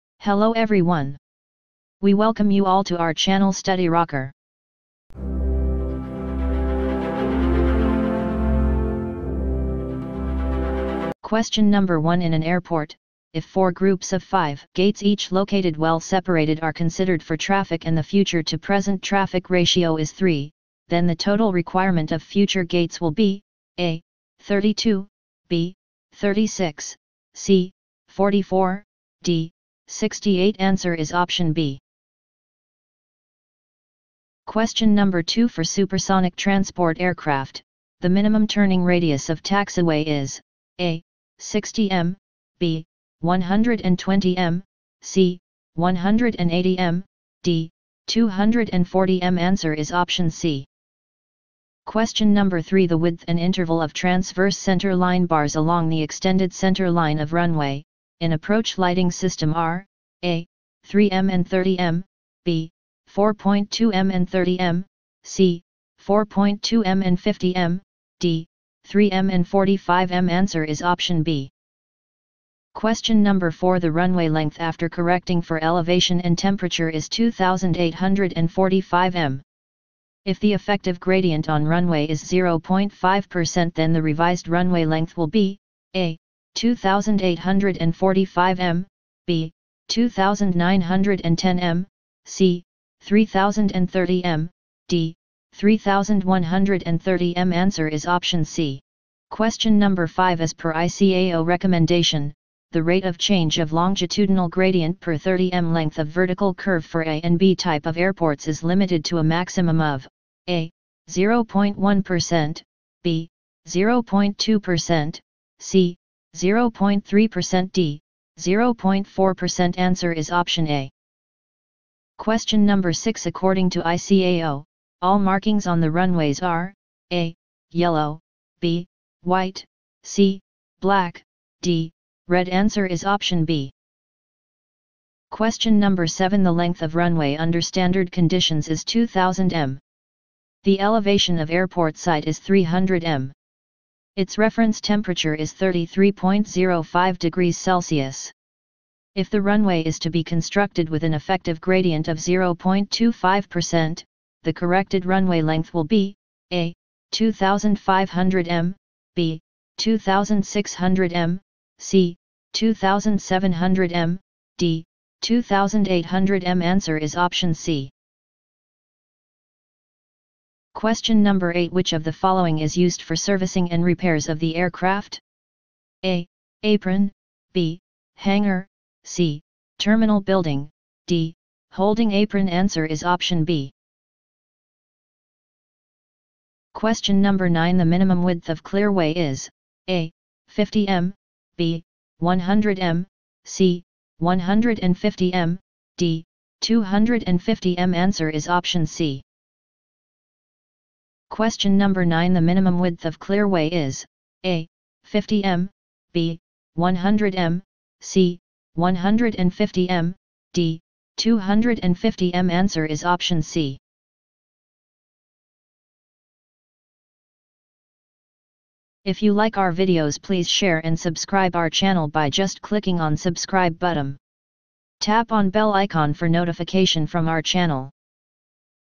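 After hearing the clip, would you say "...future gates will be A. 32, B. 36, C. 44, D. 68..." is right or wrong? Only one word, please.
right.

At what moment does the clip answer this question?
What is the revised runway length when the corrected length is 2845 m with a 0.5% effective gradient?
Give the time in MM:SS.
01:32.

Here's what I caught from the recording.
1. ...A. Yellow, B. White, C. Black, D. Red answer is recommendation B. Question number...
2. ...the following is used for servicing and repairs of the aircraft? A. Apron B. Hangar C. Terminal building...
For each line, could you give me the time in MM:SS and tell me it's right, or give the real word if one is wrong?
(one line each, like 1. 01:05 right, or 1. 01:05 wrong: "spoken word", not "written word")
1. 02:07 wrong: "option", not "recommendation"
2. 02:52 right.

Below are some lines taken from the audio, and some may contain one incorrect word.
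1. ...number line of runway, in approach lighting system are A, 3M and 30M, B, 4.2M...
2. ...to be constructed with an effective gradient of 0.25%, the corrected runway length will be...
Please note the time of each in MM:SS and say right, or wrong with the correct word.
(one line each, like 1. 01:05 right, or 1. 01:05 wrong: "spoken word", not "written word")
1. 00:56 wrong: "center", not "number"
2. 02:29 right.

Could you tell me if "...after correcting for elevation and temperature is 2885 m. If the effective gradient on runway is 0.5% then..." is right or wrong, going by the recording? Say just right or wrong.
wrong.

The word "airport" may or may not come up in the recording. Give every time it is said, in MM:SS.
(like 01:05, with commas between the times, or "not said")
00:12, 01:47, 02:21.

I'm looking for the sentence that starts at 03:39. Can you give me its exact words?
If you like our videos please share and subscribe our channel by just clicking on subscribe button.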